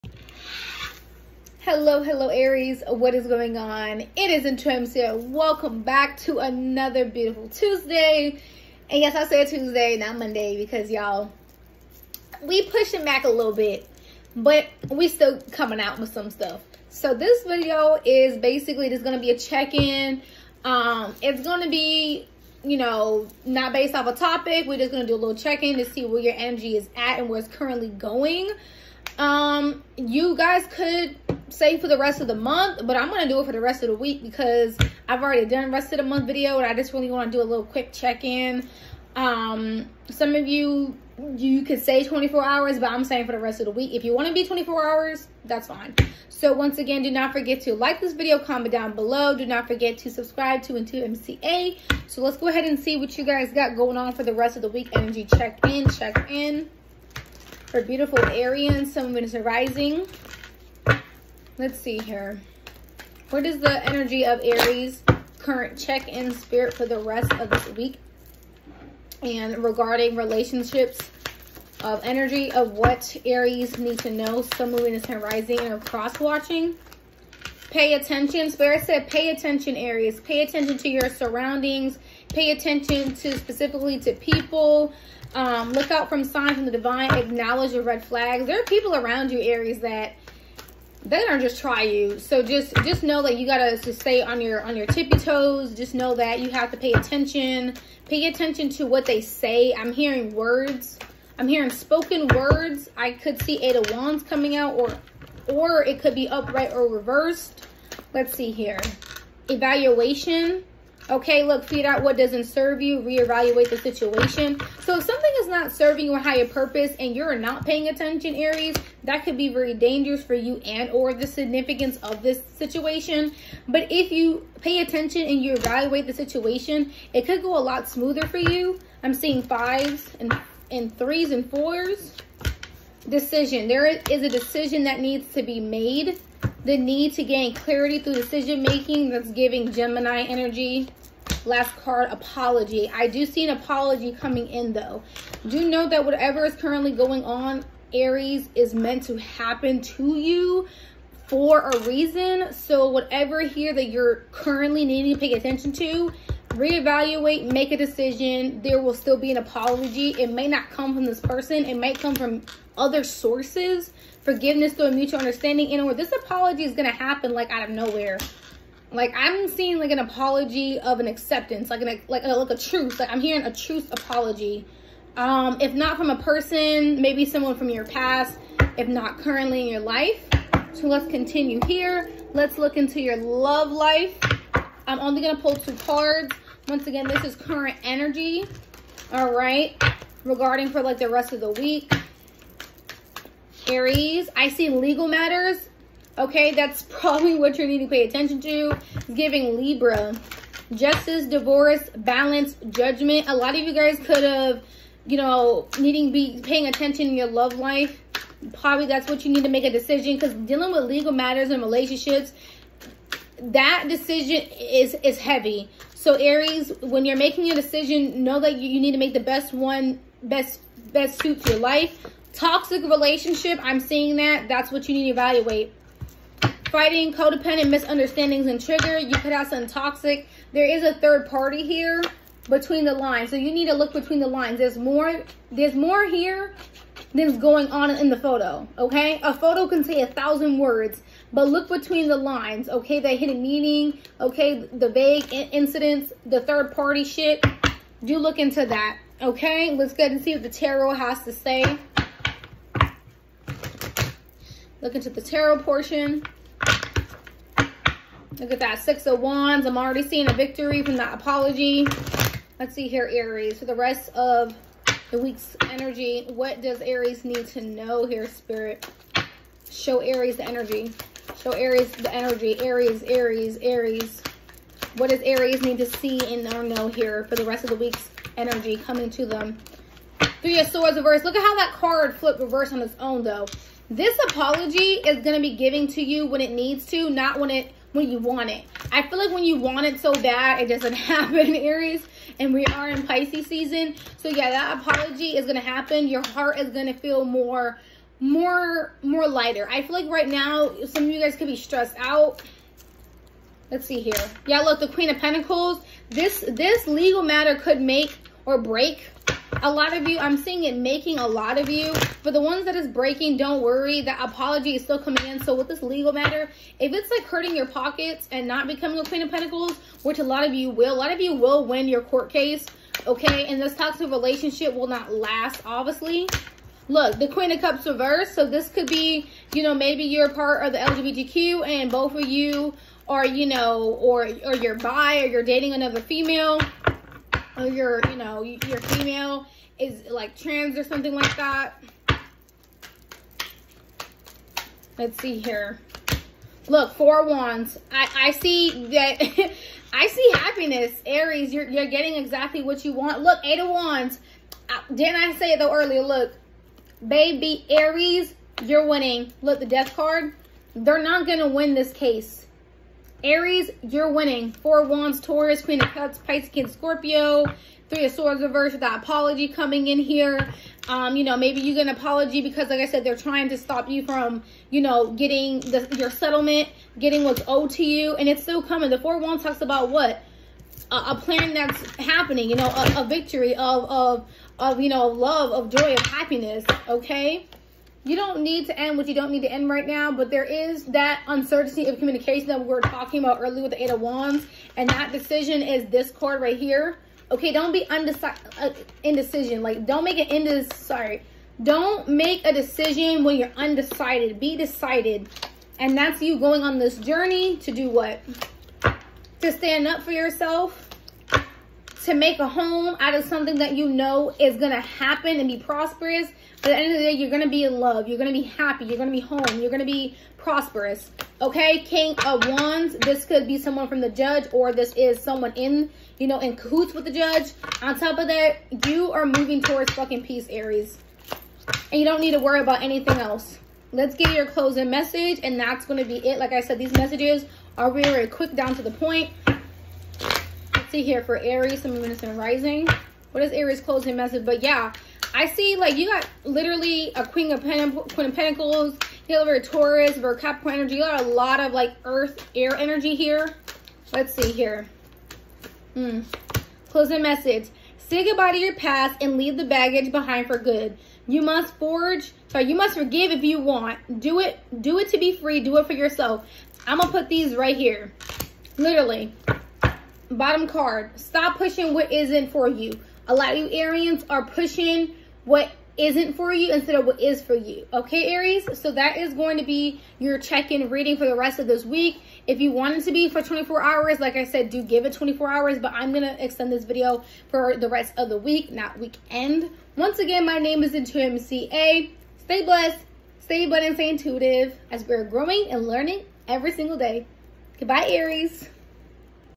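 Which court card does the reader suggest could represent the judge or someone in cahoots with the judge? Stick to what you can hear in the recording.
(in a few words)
King of Wands.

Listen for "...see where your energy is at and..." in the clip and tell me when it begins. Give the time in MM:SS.
00:25.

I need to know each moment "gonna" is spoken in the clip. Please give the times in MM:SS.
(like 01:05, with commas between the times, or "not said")
01:31, 07:46.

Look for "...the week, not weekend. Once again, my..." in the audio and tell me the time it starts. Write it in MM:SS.
08:08.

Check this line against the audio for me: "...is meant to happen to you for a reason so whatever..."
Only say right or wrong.
right.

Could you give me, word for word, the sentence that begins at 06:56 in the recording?
But at the end of the day, you're going to be in love.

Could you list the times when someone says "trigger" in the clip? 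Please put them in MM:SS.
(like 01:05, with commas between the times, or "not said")
03:48.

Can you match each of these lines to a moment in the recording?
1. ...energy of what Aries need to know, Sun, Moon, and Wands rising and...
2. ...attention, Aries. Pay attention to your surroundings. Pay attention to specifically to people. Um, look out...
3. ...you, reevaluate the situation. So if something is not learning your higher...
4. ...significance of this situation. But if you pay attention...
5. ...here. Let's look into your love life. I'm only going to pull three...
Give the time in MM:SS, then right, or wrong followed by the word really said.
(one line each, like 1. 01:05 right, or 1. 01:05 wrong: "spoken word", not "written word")
1. 01:12 wrong: "Sun", not "Wands"
2. 01:19 right
3. 01:52 wrong: "serving", not "learning"
4. 02:01 right
5. 03:01 wrong: "two", not "three".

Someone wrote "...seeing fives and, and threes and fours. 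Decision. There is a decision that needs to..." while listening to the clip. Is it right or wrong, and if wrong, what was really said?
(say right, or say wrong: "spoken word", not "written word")
right.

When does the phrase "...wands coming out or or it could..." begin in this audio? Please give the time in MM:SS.
01:43.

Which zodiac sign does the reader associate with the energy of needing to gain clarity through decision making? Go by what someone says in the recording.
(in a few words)
Gemini.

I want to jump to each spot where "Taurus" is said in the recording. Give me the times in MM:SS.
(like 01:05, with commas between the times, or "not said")
06:05, 07:29.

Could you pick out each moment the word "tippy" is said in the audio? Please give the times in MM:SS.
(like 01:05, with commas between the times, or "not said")
01:34.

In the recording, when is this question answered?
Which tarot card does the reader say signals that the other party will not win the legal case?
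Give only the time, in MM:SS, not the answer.
05:59.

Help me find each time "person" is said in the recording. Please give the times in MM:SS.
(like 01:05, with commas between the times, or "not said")
02:41, 02:56.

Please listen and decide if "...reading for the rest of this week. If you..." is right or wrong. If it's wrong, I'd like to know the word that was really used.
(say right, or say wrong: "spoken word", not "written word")
right.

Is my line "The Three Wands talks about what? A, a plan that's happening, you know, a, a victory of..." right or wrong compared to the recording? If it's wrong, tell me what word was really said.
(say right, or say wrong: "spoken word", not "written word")
wrong: "Four", not "Three".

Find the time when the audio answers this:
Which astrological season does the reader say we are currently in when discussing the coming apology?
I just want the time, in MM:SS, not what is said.
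04:53.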